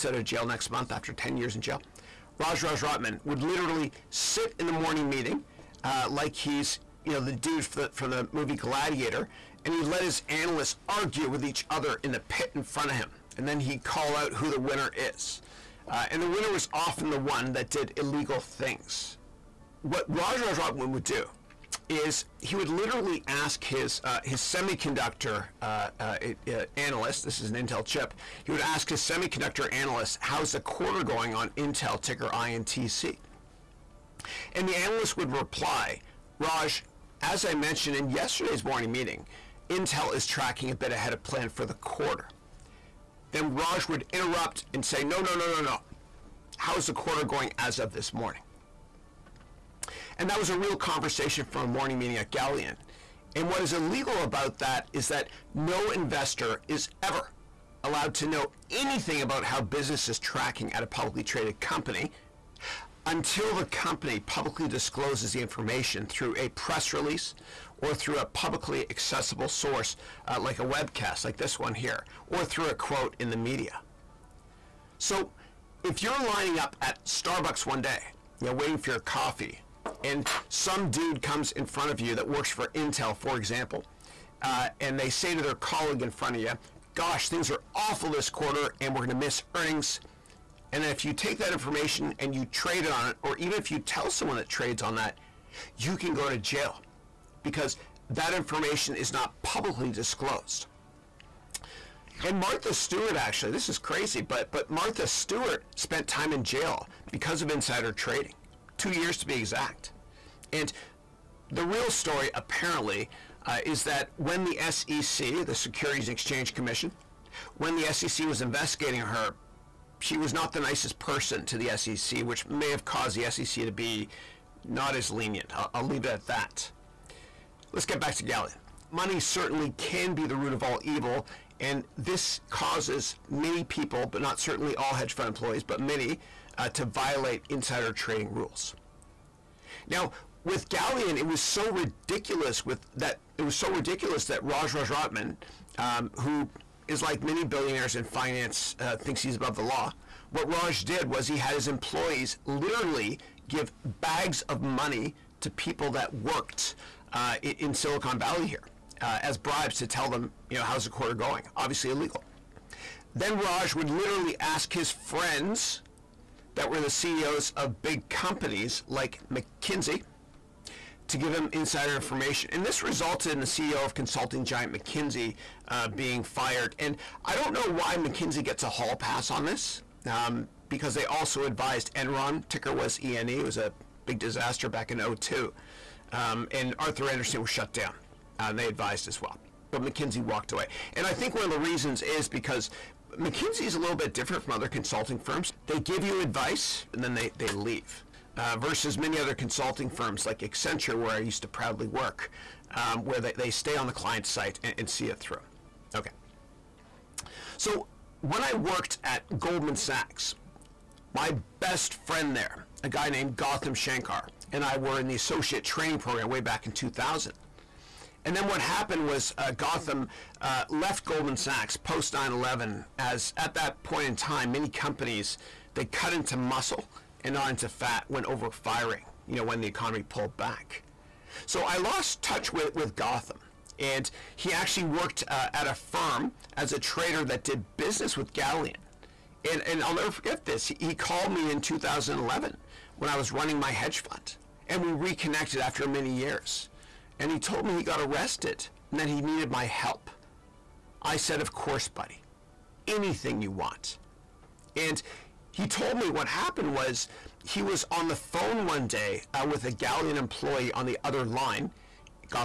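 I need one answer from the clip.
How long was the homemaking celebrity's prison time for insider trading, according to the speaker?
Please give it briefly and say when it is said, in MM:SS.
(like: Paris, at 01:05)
2 years, at 01:48.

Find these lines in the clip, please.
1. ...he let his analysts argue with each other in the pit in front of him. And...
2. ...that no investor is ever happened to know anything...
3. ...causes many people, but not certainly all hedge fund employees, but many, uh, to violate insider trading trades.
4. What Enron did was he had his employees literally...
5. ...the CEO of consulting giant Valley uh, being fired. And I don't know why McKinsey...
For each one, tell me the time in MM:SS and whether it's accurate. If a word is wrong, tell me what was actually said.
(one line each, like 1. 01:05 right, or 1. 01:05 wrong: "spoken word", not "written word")
1. 00:09 right
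2. 00:55 wrong: "allowed", not "happened"
3. 02:12 wrong: "rules", not "trades"
4. 02:30 wrong: "Raj", not "Enron"
5. 02:53 wrong: "McKinsey", not "Valley".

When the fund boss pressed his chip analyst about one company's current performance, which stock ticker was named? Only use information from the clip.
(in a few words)
INTC.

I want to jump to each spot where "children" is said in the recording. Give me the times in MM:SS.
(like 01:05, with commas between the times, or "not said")
not said.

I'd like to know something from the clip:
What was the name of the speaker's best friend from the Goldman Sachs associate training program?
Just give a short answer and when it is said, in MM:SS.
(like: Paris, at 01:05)
Gautham Shankar, at 03:33.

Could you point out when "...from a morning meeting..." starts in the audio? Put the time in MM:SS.
00:51.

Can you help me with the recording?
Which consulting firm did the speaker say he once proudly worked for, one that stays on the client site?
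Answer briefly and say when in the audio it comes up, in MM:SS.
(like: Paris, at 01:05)
Accenture, at 03:20.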